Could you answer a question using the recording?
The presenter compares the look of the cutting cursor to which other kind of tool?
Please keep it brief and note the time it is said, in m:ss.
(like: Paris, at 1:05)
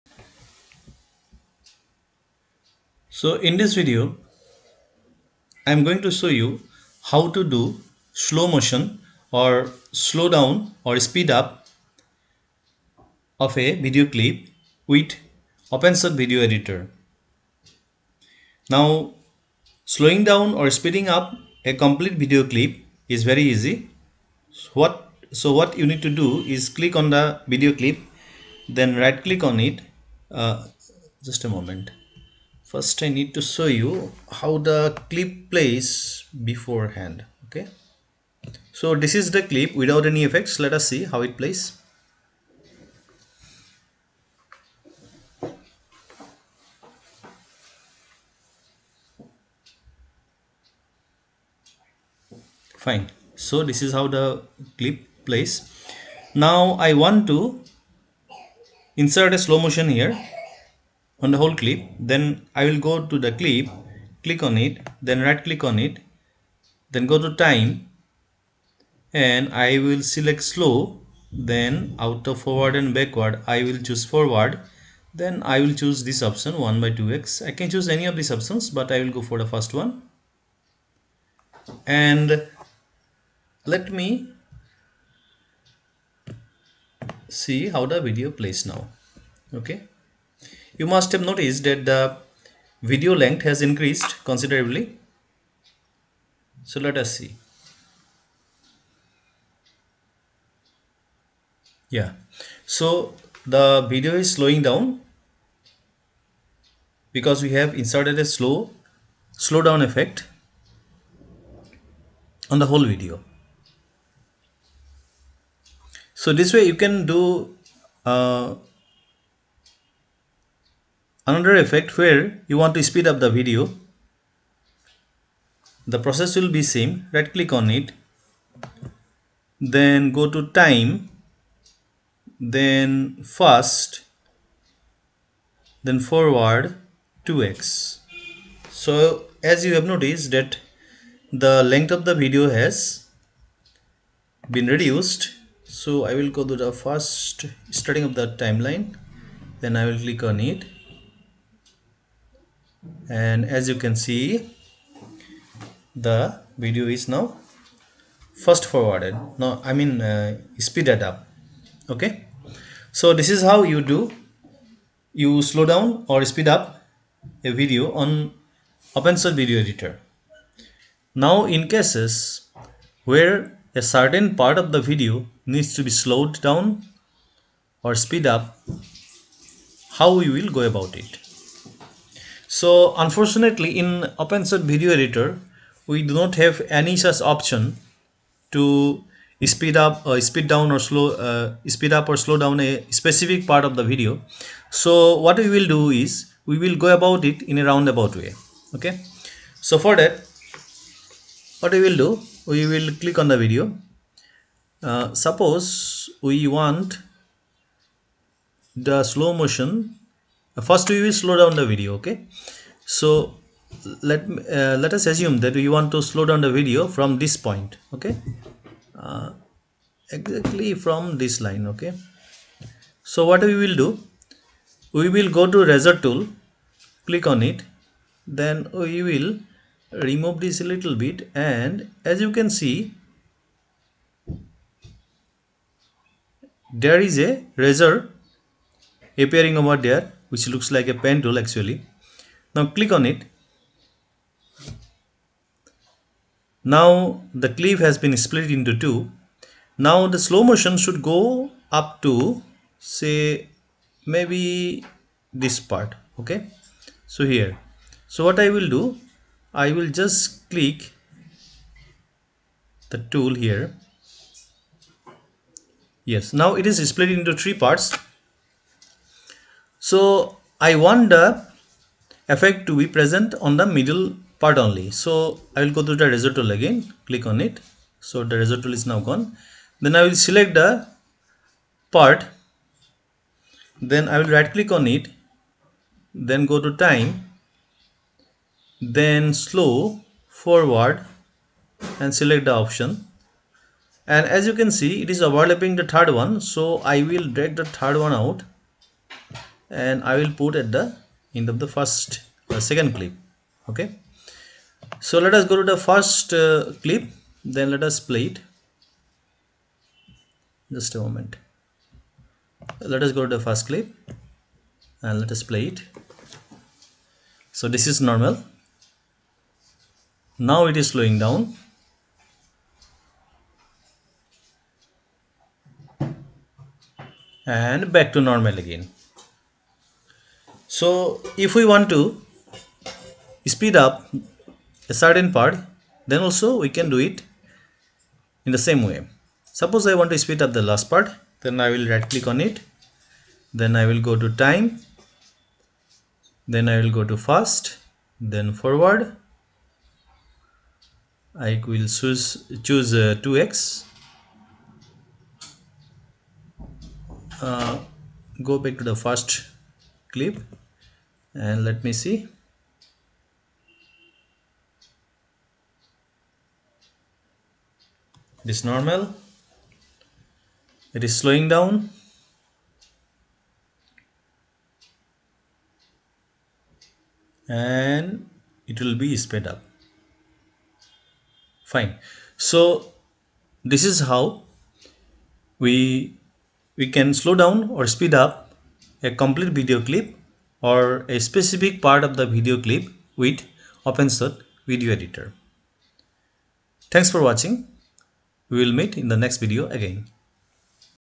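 pen tool, at 4:00.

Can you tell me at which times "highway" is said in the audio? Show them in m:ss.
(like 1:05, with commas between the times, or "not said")
not said.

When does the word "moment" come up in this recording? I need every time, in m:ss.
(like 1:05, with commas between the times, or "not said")
0:31, 5:10.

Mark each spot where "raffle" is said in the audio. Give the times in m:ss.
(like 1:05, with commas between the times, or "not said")
not said.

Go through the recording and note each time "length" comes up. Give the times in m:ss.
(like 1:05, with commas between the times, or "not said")
1:33, 2:21.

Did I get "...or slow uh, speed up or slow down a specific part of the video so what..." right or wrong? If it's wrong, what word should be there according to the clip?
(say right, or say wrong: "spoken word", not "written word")
right.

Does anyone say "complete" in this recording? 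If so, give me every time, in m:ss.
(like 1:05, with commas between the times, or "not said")
0:21, 6:29.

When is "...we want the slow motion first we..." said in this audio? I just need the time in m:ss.
3:26.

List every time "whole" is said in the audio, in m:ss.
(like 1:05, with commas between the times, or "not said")
1:01, 1:52.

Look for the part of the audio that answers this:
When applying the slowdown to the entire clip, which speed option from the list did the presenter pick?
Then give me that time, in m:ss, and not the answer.
1:16.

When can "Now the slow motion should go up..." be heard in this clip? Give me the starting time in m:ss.
4:09.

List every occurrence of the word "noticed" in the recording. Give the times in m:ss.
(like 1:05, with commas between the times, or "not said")
1:31, 2:19.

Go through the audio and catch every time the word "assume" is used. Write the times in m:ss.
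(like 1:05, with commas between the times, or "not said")
3:35.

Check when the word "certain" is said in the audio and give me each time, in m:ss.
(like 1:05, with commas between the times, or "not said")
2:53, 5:34.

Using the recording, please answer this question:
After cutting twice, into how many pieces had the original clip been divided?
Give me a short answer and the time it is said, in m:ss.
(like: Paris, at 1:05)
3, at 4:27.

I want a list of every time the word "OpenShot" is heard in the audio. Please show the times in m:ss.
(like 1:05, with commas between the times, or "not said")
0:15, 2:48, 3:04, 6:33.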